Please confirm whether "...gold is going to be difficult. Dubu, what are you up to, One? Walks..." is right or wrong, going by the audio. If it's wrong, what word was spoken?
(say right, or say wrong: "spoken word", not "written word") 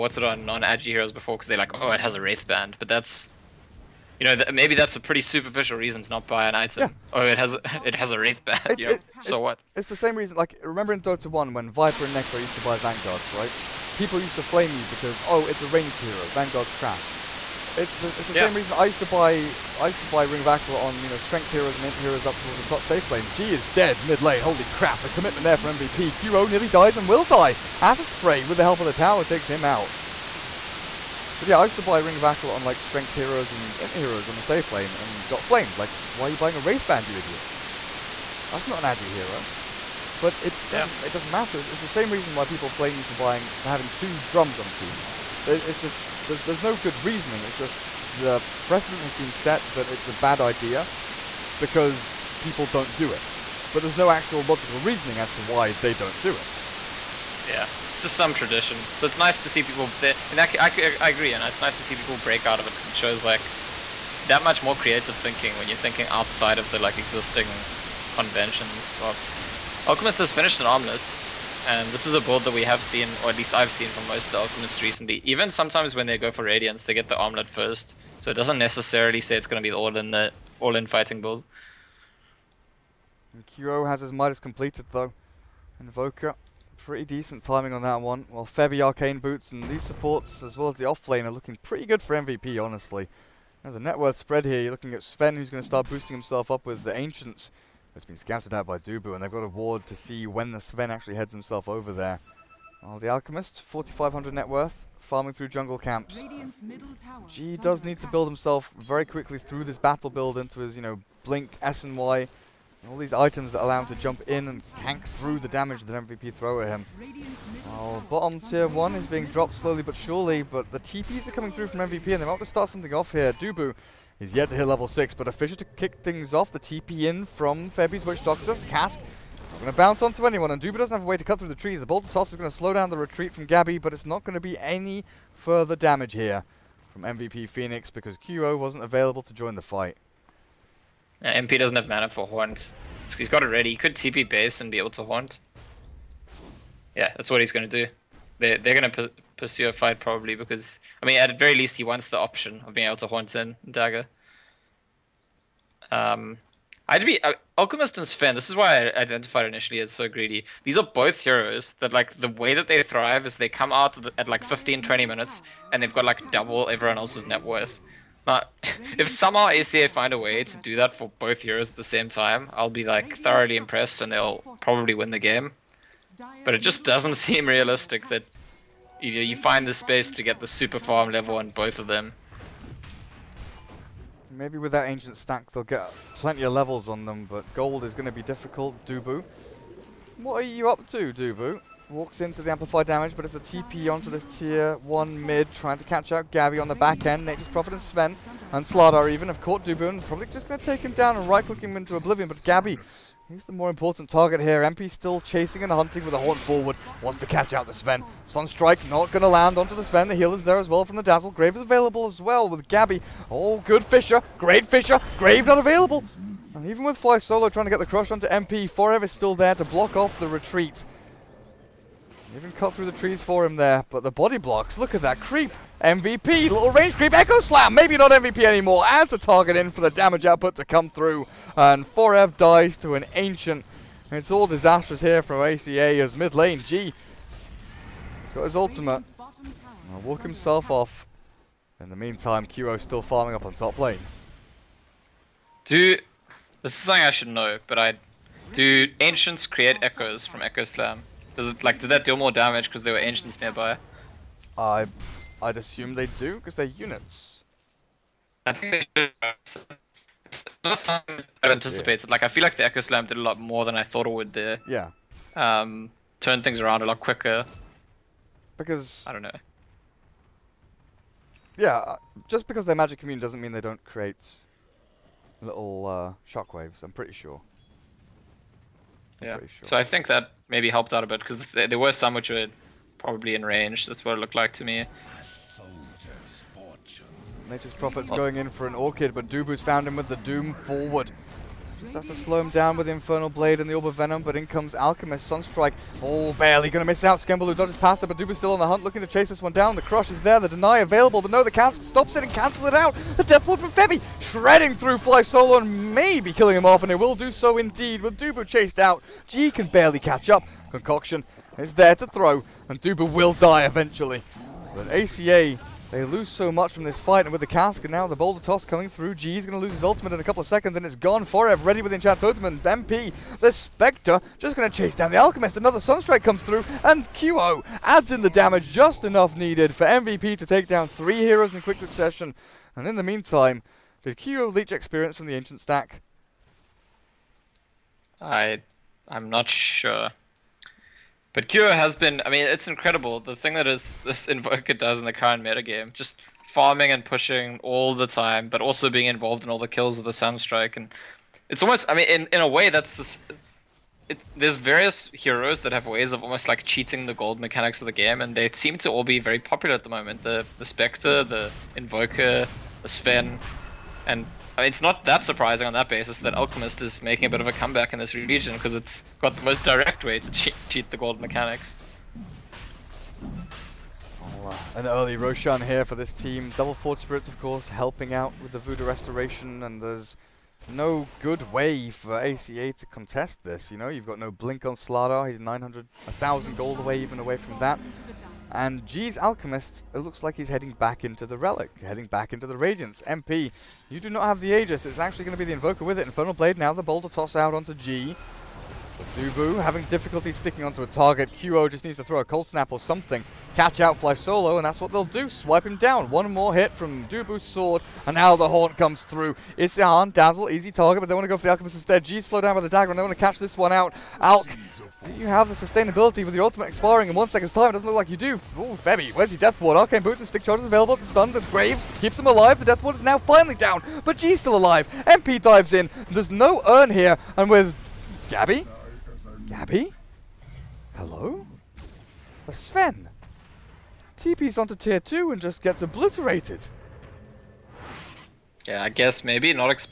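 wrong: "Dubu", not "One".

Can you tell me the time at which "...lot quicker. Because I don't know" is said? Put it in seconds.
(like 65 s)
266 s.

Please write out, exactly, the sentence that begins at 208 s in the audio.
Sunstrike not going to land onto the Sven.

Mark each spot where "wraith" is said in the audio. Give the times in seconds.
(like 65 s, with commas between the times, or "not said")
2 s, 8 s, 36 s.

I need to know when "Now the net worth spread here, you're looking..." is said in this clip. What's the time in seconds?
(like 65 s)
93 s.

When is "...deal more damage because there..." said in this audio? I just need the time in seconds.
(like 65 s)
252 s.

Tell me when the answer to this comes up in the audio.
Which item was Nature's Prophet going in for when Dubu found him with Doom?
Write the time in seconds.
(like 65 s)
288 s.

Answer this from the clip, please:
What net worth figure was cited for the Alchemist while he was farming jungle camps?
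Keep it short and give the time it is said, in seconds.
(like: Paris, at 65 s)
4,500, at 103 s.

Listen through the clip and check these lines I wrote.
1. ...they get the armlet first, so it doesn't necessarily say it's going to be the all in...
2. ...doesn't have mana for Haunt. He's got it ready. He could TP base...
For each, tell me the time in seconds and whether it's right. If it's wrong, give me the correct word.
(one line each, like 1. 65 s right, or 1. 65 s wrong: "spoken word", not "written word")
1. 76 s right
2. 141 s right.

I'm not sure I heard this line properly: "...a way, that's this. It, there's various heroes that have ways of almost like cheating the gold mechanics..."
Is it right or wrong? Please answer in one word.
right.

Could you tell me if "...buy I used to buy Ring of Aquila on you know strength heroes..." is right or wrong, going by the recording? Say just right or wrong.
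right.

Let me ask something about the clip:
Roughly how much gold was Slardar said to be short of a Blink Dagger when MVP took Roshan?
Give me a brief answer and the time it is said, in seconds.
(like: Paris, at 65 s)
900 to 1,000, at 385 s.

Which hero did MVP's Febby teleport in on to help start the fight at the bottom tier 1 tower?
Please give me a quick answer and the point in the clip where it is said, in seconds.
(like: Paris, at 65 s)
Witch Doctor, at 128 s.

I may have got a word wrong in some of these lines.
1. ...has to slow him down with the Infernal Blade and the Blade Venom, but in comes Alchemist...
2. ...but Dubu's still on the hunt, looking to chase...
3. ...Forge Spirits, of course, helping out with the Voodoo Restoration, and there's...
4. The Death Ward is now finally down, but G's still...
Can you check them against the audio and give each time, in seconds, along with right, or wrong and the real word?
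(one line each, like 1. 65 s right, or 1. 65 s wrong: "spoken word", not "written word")
1. 291 s wrong: "Orb", not "Blade"
2. 298 s right
3. 376 s right
4. 422 s right.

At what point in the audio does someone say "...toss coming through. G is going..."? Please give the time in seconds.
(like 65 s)
318 s.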